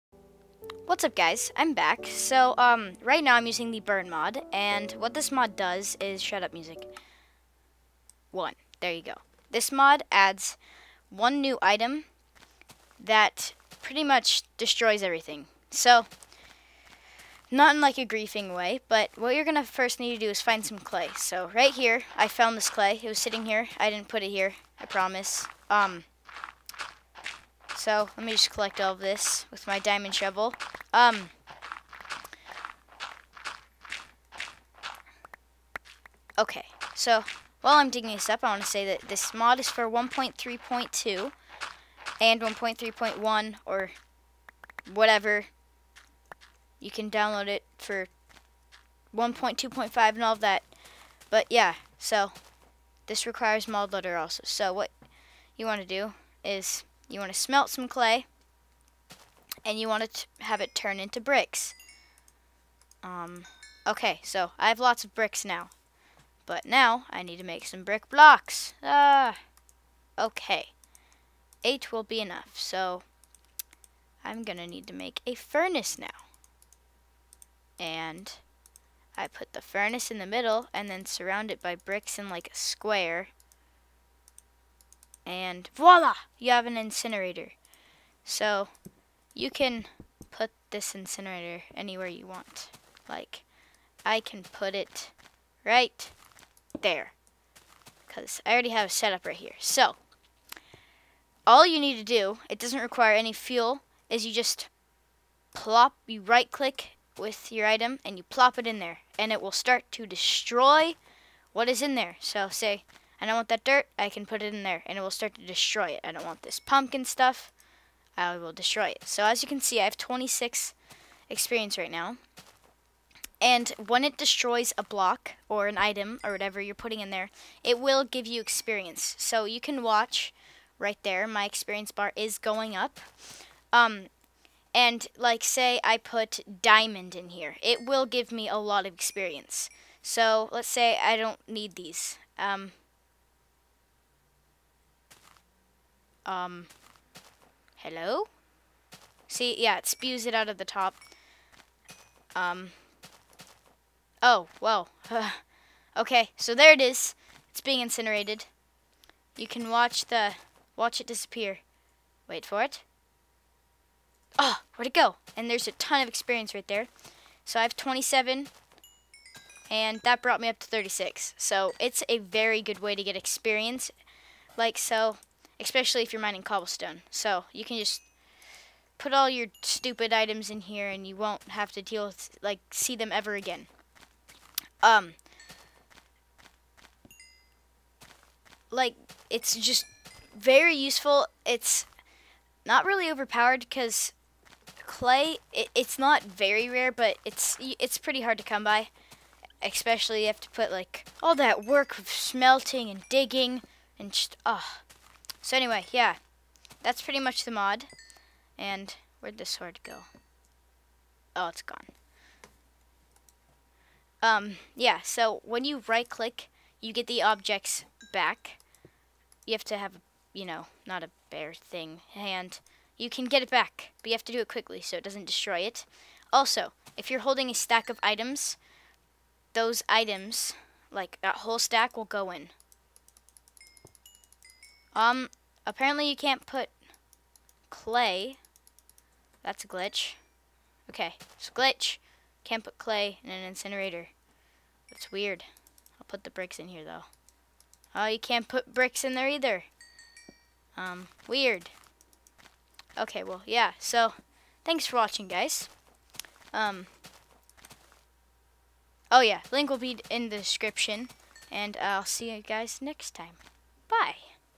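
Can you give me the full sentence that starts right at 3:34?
Um, yeah, so when you right-click, you get the objects back.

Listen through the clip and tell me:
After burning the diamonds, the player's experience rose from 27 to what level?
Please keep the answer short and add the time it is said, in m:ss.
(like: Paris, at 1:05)
36, at 2:50.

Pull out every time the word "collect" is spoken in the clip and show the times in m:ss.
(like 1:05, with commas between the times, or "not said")
0:28.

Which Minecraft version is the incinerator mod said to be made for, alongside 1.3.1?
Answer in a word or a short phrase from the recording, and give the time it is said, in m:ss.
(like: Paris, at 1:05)
1.3.2, at 0:39.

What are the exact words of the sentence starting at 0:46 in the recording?
You can download it for 1.2.5 and all of that.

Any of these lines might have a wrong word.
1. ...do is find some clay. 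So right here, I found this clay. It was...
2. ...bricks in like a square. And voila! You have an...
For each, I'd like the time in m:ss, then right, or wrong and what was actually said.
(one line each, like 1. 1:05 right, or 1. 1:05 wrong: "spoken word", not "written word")
1. 0:20 right
2. 1:21 right.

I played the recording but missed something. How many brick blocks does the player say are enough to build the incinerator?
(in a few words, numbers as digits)
8.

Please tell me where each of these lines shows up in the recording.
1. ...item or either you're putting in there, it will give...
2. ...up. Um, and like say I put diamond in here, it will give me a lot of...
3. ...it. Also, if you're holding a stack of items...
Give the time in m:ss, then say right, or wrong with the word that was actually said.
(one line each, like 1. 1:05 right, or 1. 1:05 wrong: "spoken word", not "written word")
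1. 2:05 wrong: "whatever", not "either"
2. 2:12 right
3. 3:45 right.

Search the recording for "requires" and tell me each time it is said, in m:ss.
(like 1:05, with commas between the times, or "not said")
0:53, 1:42.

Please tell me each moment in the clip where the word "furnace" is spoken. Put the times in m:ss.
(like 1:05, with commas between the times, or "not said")
1:15, 1:19.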